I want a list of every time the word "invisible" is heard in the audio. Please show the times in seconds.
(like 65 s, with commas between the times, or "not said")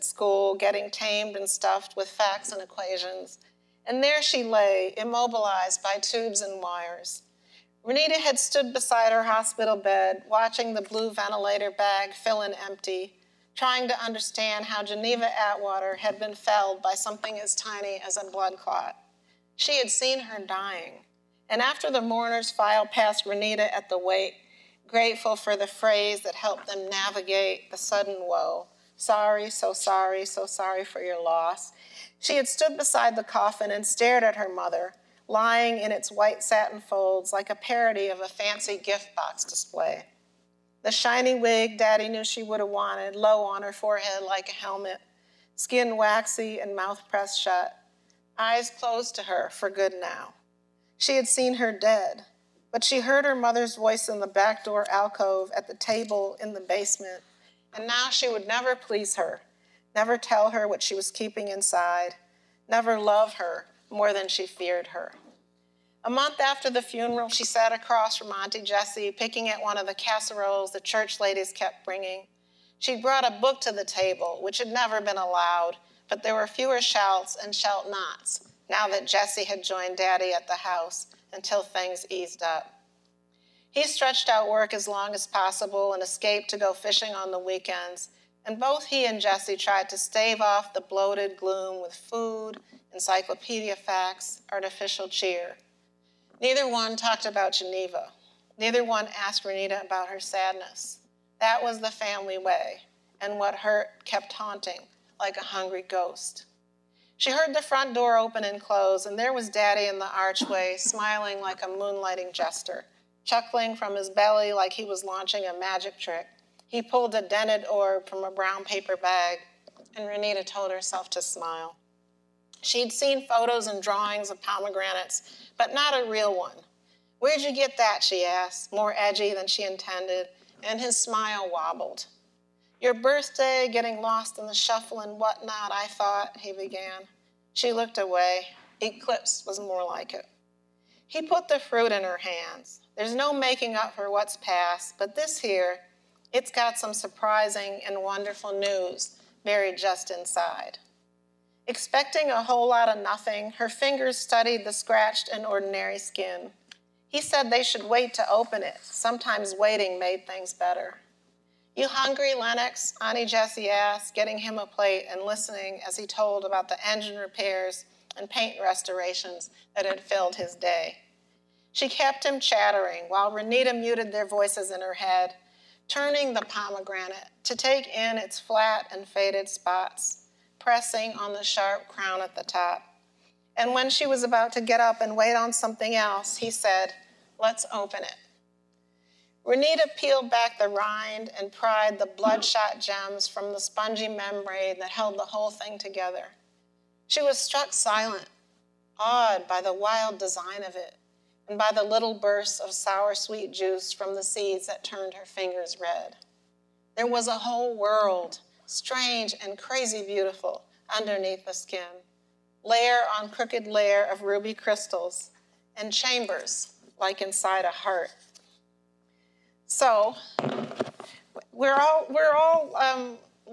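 not said.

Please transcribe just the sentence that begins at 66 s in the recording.
A month after the funeral, she sat across from Auntie Jessie, picking at one of the casseroles the church ladies kept bringing.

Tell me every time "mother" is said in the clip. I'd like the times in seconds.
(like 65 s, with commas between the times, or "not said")
34 s, 53 s.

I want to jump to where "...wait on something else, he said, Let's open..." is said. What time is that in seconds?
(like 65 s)
185 s.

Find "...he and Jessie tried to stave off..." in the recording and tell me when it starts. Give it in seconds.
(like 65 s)
88 s.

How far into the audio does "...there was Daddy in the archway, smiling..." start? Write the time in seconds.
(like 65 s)
109 s.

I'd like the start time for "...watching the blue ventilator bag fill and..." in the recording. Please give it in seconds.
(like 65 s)
10 s.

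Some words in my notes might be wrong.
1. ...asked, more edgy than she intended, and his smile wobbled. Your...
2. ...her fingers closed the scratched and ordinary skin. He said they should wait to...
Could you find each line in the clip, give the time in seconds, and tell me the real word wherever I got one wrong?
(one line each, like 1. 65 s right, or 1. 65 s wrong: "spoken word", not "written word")
1. 128 s right
2. 153 s wrong: "studied", not "closed".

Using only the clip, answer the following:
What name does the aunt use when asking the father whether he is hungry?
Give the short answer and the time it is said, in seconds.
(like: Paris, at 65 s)
Lennox, at 162 s.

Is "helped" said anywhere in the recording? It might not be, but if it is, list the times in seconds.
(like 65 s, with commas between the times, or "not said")
26 s.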